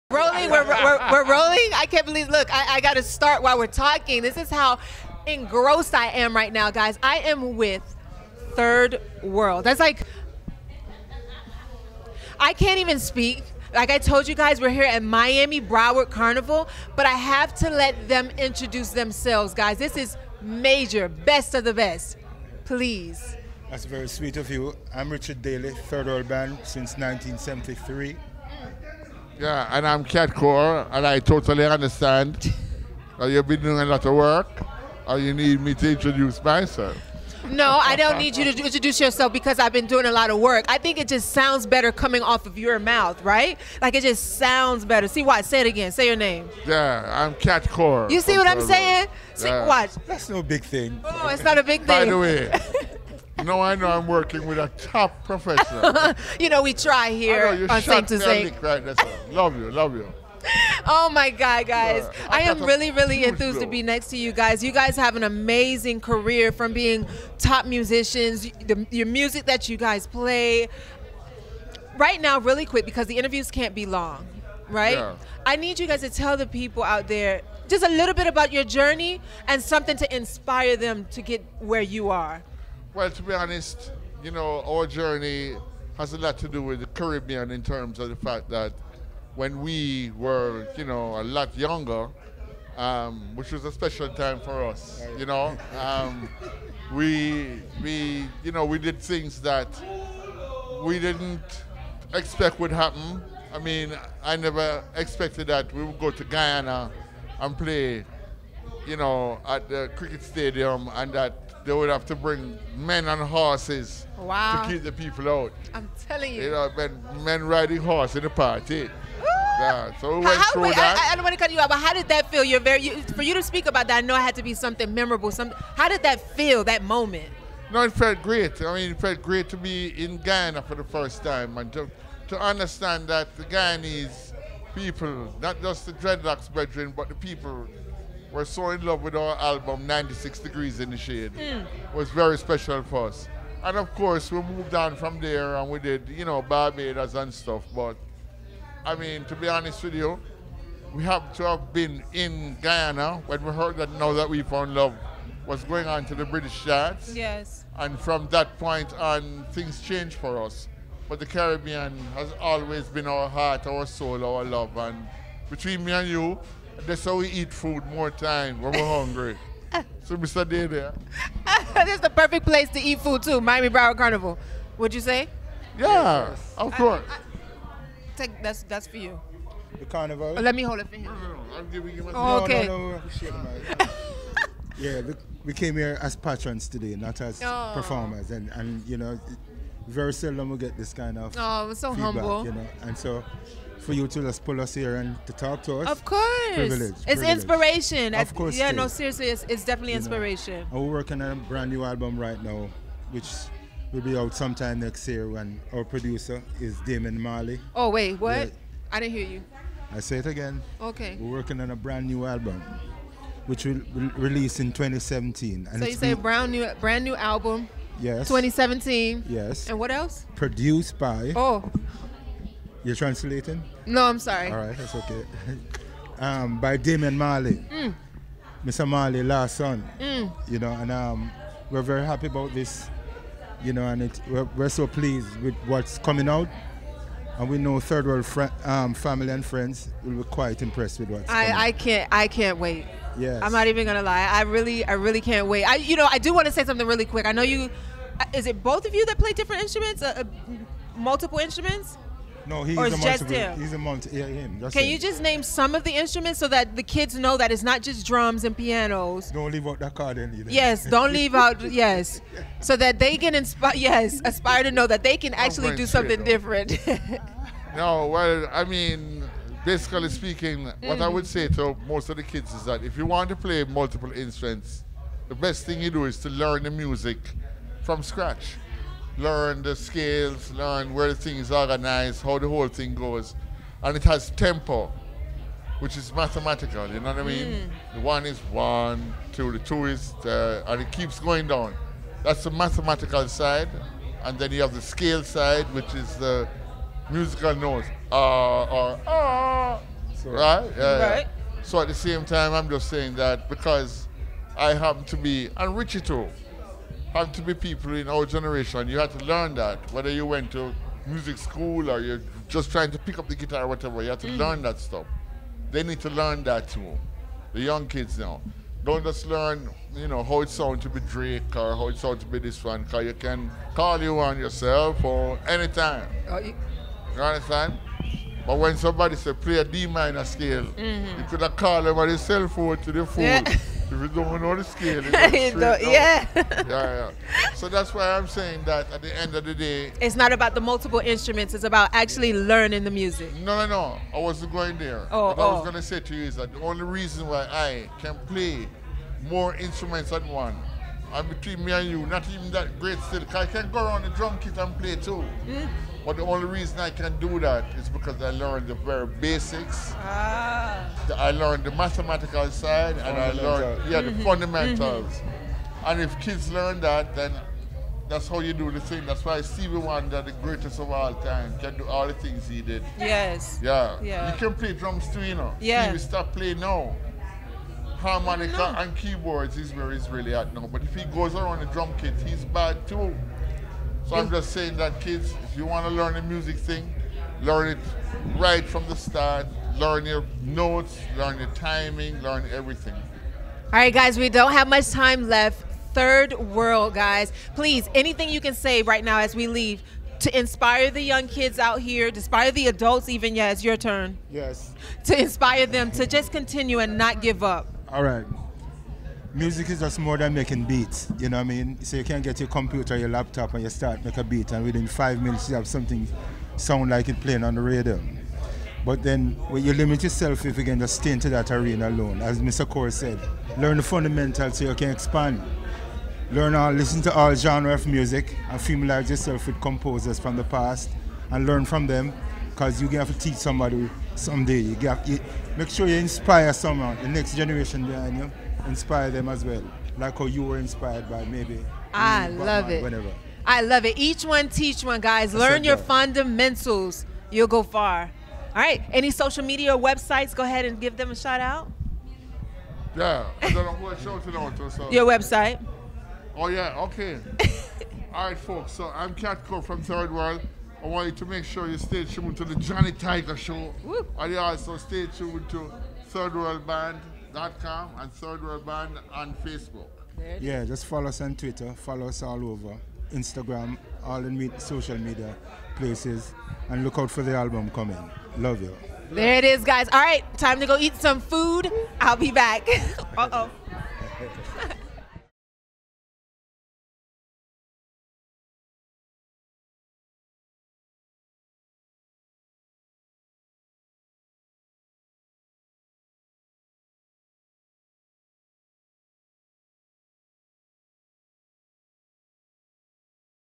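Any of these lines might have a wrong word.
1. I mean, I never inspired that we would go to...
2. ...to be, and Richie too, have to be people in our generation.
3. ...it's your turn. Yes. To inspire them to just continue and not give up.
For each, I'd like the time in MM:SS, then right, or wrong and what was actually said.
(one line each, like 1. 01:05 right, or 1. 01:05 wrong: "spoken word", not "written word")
1. 01:43 wrong: "expected", not "inspired"
2. 05:05 right
3. 06:43 right.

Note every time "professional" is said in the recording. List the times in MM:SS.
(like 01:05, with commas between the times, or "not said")
00:55.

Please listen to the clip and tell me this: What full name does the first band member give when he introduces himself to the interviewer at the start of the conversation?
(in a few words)
Richard Daley.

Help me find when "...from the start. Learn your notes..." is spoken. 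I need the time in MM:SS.
06:28.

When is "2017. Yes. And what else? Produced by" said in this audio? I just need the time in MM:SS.
03:38.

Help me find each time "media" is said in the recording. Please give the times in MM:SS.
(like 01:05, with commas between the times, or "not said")
07:29, 07:54.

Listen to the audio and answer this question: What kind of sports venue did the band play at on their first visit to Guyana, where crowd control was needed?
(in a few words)
Cricket stadium.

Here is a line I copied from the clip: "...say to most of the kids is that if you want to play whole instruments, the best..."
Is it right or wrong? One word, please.
wrong.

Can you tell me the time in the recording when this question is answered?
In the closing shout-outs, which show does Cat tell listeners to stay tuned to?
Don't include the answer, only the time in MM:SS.
07:42.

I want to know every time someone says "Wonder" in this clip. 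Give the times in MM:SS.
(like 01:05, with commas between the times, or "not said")
06:09.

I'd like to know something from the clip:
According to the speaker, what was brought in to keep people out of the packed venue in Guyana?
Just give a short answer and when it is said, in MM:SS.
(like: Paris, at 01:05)
Men on horses, at 01:52.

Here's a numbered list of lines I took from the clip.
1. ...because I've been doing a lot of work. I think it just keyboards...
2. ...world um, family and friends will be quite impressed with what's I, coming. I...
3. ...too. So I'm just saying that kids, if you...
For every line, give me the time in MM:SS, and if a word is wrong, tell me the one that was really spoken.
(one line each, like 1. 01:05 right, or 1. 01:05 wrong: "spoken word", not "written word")
1. 00:39 wrong: "sounds", not "keyboards"
2. 03:58 right
3. 06:22 right.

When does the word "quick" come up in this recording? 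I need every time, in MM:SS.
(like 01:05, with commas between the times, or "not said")
01:12, 04:07.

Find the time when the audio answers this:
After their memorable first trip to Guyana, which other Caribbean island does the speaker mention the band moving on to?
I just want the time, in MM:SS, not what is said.
02:26.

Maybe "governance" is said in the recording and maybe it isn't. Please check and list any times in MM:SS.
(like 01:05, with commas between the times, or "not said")
not said.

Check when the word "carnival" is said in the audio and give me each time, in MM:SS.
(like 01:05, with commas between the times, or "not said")
00:16, 02:53, 02:59.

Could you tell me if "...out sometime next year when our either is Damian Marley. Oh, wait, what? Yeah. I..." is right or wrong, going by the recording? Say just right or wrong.
wrong.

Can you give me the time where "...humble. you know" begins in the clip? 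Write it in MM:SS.
03:12.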